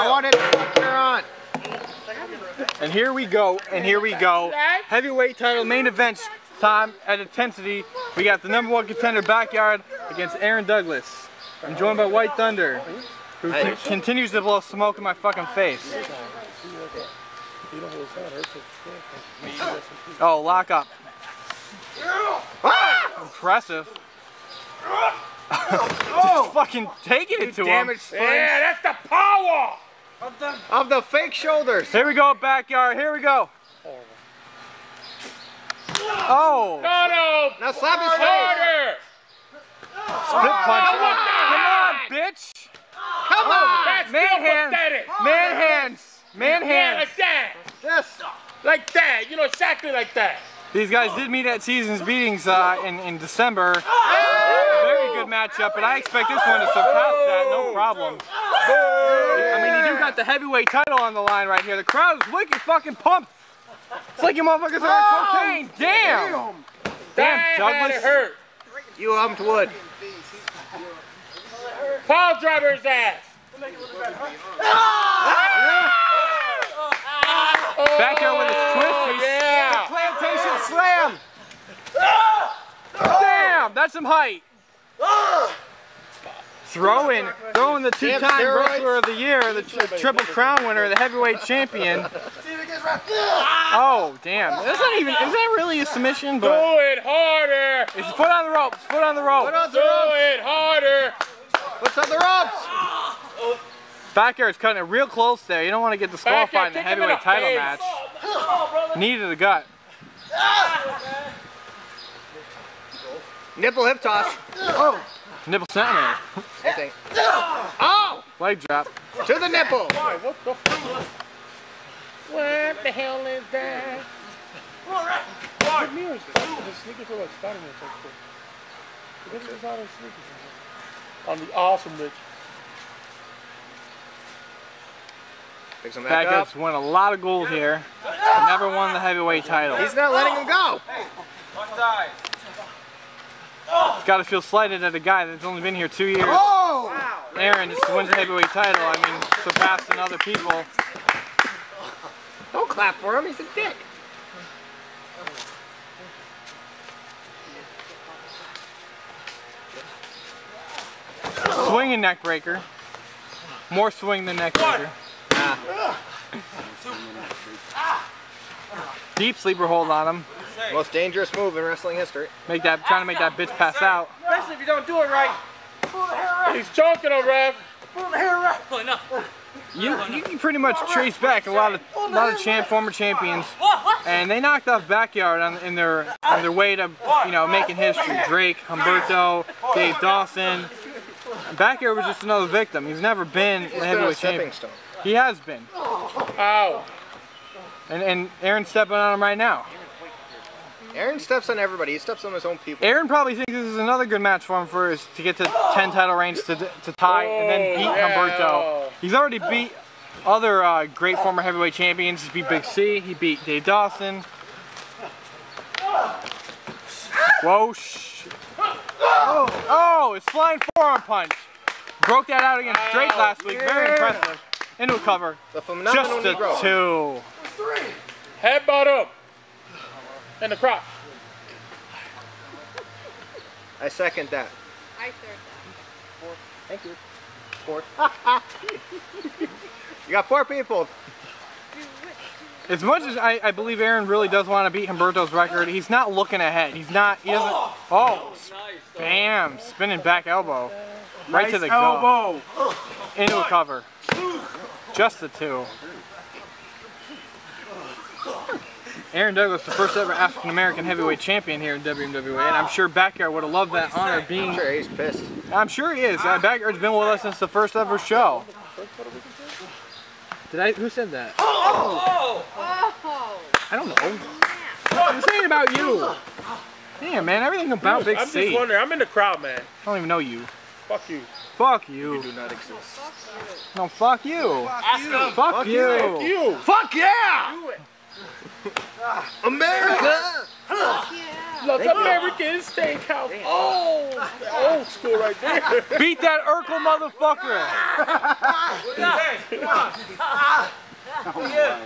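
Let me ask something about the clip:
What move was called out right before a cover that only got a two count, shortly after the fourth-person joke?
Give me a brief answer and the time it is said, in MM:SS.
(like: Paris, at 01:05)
Spinning back elbow, at 04:09.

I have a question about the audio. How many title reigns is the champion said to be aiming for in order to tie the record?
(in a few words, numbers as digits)
10.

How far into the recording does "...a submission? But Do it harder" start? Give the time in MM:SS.
01:35.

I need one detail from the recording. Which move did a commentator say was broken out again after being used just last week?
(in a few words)
Flying forearm punch.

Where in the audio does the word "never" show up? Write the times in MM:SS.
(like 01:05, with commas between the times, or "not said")
02:18, 03:13.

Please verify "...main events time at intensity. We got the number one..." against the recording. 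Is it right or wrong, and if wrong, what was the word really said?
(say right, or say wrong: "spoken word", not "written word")
right.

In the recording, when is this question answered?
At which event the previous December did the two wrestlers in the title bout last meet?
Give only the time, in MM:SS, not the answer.
00:51.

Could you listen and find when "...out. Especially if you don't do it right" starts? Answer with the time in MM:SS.
02:53.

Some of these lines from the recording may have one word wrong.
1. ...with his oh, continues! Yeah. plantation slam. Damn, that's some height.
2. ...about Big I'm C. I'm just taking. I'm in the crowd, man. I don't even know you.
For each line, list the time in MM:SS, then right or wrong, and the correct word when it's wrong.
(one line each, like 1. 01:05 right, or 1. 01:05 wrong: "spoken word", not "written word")
1. 01:18 wrong: "twisties", not "continues"
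2. 04:37 wrong: "wondering", not "taking".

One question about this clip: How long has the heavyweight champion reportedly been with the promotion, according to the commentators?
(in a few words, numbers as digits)
2 years.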